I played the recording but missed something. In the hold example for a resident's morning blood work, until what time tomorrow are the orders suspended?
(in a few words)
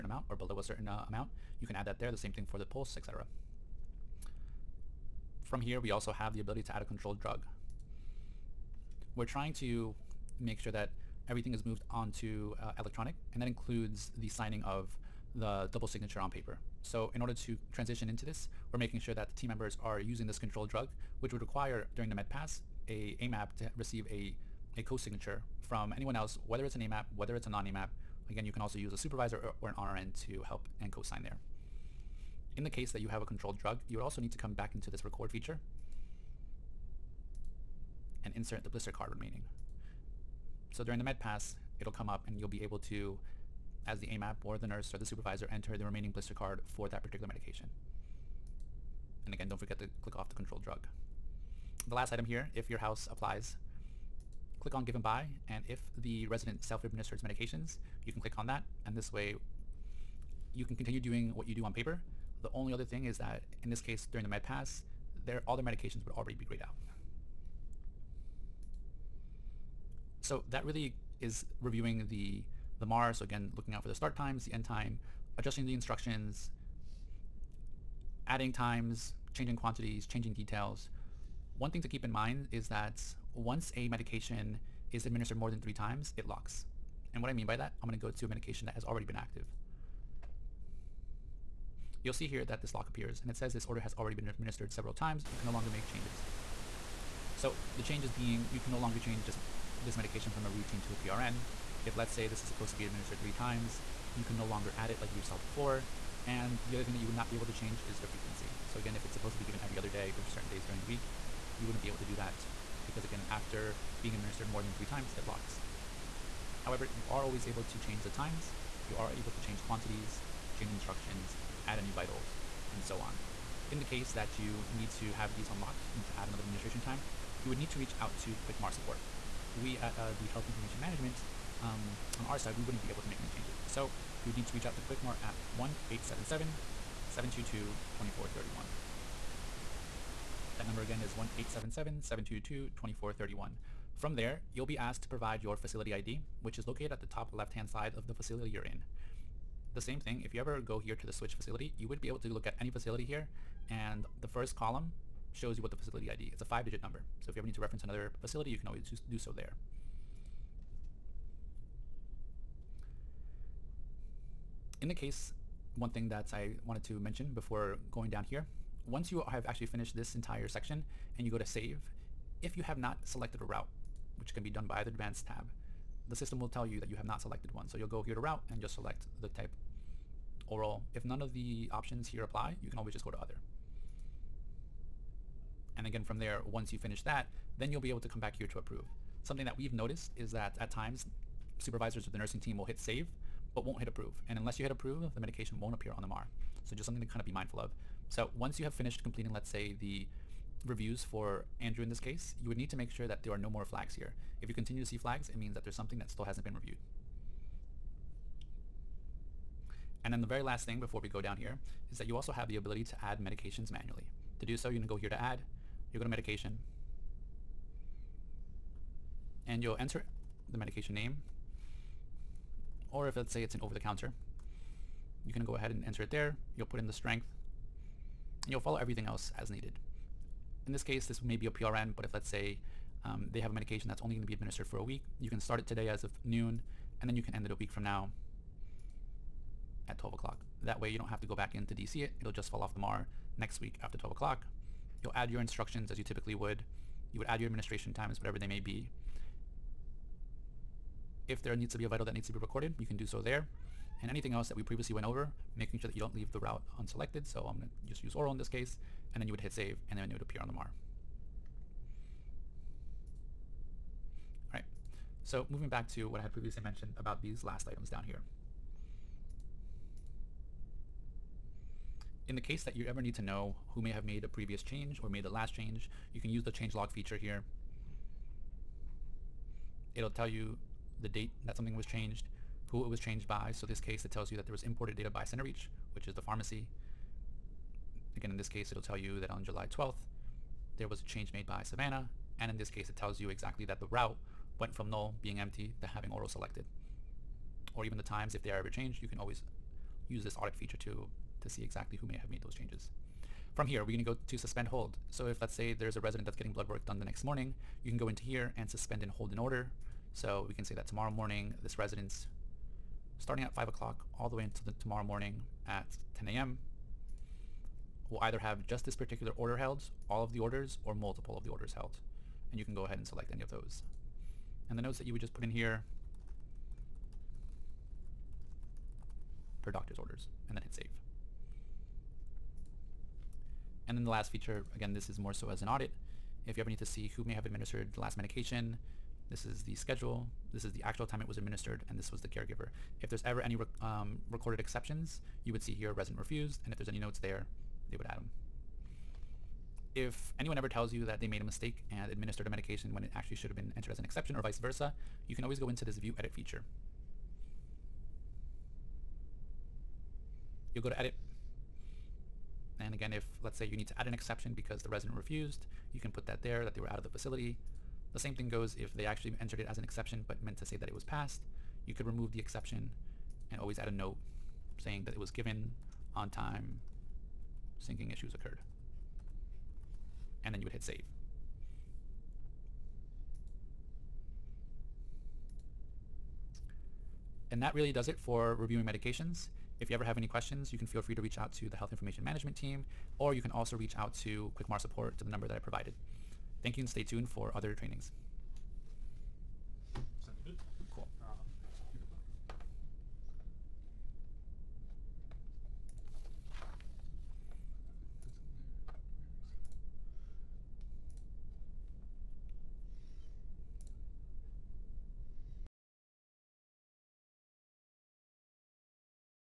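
10 a.m.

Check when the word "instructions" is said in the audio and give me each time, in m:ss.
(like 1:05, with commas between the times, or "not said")
1:15, 2:00, 4:05.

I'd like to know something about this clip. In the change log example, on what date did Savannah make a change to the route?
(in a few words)
July 12th.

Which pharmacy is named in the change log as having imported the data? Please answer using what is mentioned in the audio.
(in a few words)
CenterReach.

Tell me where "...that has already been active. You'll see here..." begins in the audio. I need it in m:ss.
1:28.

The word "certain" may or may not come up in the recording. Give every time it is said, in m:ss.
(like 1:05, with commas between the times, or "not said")
0:00, 1:50.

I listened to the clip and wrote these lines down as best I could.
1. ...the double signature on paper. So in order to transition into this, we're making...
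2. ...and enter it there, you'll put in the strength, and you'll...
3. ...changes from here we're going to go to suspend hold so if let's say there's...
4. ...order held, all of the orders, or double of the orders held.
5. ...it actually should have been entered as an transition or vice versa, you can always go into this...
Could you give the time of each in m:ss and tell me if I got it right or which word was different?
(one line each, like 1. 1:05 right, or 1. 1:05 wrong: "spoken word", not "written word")
1. 0:15 right
2. 3:45 right
3. 5:02 right
4. 5:19 wrong: "multiple", not "double"
5. 5:53 wrong: "exception", not "transition".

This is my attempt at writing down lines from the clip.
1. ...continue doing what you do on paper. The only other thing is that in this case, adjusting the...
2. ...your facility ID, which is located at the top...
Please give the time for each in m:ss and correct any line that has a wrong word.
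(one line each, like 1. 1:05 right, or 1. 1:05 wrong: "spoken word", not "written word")
1. 1:00 wrong: "during", not "adjusting"
2. 2:25 right.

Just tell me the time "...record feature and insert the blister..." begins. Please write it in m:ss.
0:35.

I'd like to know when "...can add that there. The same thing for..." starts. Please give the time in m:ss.
0:01.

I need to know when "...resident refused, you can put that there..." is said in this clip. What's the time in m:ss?
6:04.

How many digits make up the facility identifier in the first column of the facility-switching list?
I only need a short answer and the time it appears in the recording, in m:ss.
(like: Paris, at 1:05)
5, at 2:36.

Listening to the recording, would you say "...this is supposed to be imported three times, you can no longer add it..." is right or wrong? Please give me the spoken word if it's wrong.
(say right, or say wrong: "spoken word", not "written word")
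wrong: "administered", not "imported".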